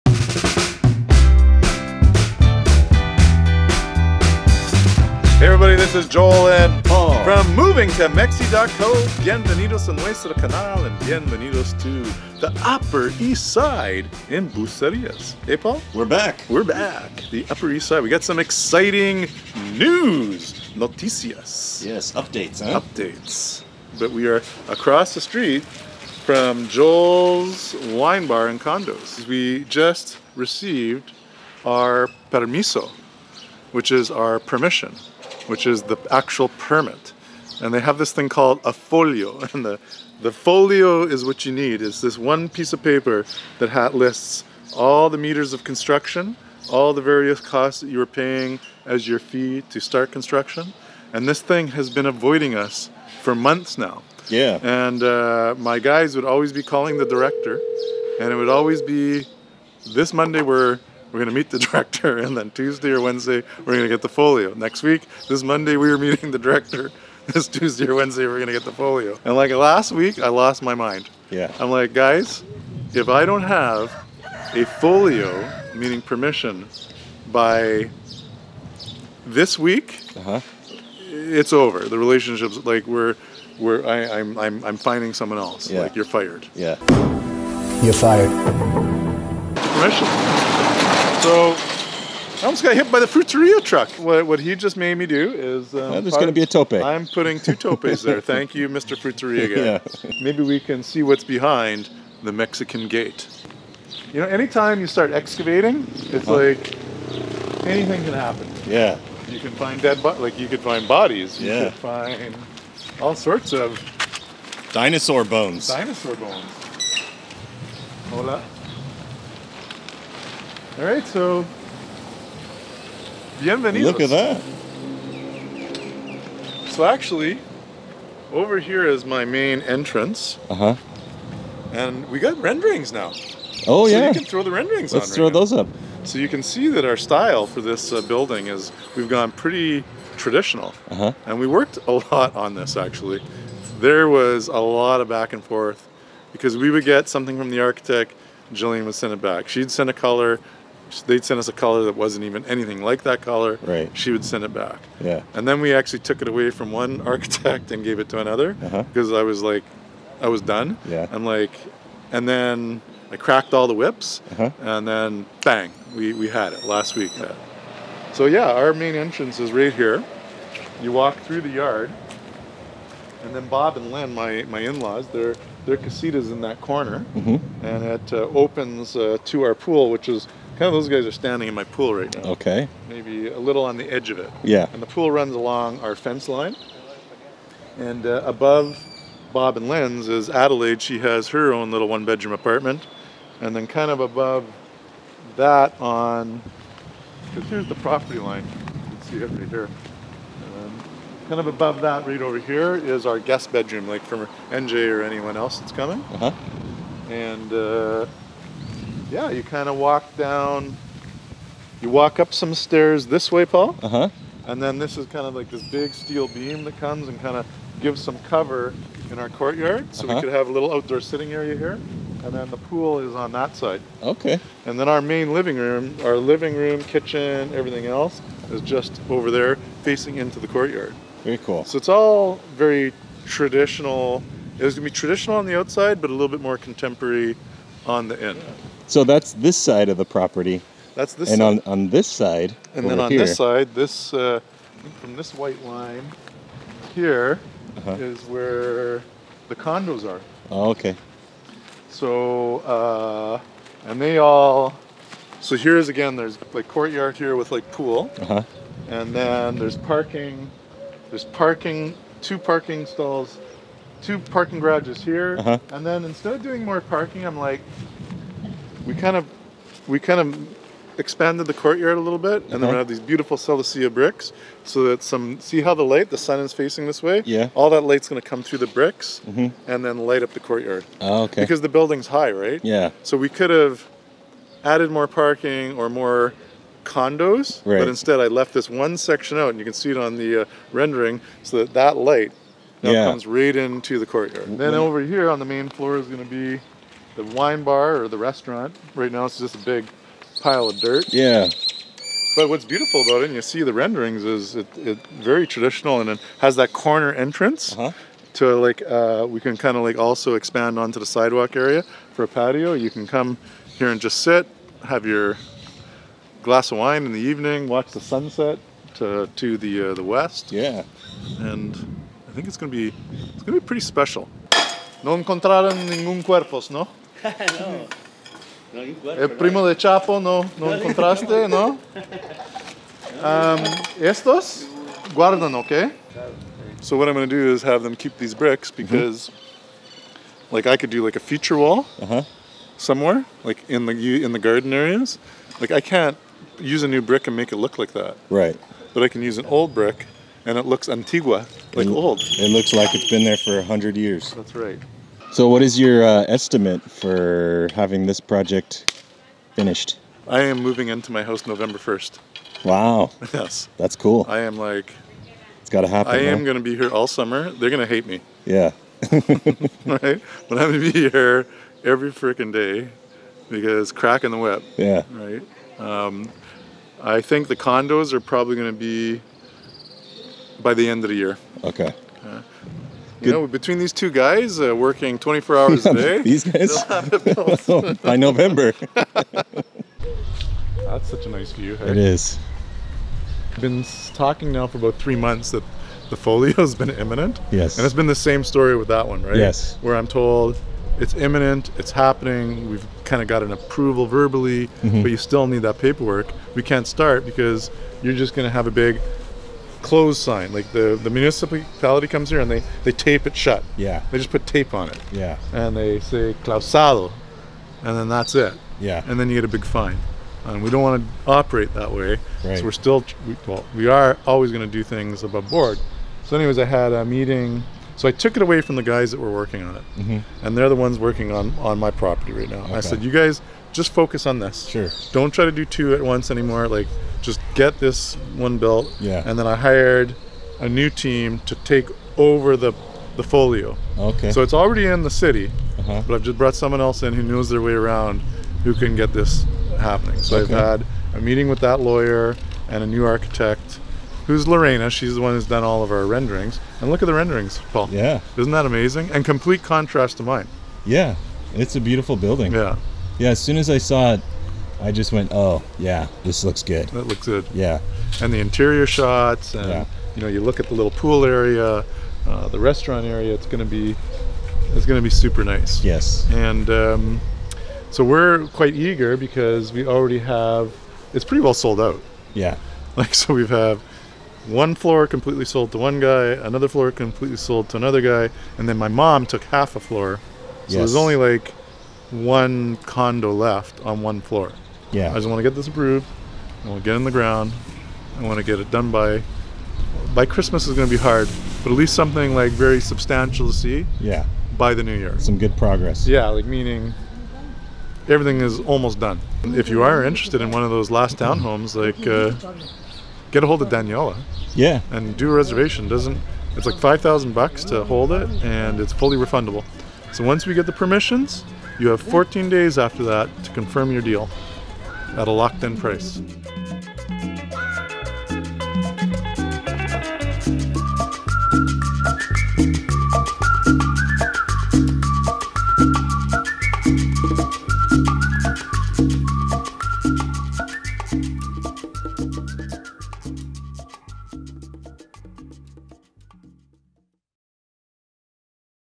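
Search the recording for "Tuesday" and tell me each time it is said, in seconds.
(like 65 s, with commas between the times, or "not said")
62 s, 67 s.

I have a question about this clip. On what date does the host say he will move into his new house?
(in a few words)
November 1.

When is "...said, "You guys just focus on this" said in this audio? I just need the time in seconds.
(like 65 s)
432 s.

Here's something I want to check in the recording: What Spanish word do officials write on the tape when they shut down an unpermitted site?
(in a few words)
clausado.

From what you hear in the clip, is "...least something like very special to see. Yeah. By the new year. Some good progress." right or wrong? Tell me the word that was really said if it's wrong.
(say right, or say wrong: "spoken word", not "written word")
wrong: "substantial", not "special".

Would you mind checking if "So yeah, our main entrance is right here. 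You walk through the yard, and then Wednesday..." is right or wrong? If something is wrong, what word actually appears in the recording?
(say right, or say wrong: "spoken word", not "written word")
wrong: "Bob", not "Wednesday".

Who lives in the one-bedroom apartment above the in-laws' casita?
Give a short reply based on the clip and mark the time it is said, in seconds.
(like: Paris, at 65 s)
Adelaide, at 190 s.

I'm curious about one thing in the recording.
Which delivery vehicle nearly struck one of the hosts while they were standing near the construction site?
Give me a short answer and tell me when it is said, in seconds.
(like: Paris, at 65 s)
Fruteria truck, at 93 s.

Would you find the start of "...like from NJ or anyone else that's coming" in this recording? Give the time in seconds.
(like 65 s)
203 s.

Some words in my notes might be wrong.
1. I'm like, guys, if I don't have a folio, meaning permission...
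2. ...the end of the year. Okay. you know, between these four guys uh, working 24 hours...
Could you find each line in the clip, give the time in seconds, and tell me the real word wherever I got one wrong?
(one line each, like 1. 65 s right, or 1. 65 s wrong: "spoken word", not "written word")
1. 71 s right
2. 380 s wrong: "two", not "four".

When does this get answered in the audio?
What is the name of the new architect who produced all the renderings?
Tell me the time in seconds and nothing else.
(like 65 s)
454 s.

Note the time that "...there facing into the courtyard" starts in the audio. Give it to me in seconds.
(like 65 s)
229 s.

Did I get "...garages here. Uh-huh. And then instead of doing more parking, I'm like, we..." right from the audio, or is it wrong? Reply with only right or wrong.
right.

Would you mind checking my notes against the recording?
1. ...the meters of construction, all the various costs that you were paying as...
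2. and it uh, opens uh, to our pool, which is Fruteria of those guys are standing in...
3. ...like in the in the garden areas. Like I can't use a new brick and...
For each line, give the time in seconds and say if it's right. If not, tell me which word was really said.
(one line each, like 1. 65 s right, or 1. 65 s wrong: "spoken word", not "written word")
1. 45 s right
2. 177 s wrong: "Kind", not "Fruteria"
3. 343 s right.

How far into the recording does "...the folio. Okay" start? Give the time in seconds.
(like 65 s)
443 s.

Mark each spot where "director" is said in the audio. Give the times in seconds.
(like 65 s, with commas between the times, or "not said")
57 s, 61 s, 66 s.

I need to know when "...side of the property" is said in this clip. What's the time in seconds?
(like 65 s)
239 s.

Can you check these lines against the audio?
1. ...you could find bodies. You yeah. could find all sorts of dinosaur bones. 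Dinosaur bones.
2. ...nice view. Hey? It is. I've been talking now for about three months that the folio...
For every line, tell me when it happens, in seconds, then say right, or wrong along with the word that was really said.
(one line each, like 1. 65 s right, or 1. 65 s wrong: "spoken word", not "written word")
1. 110 s right
2. 391 s right.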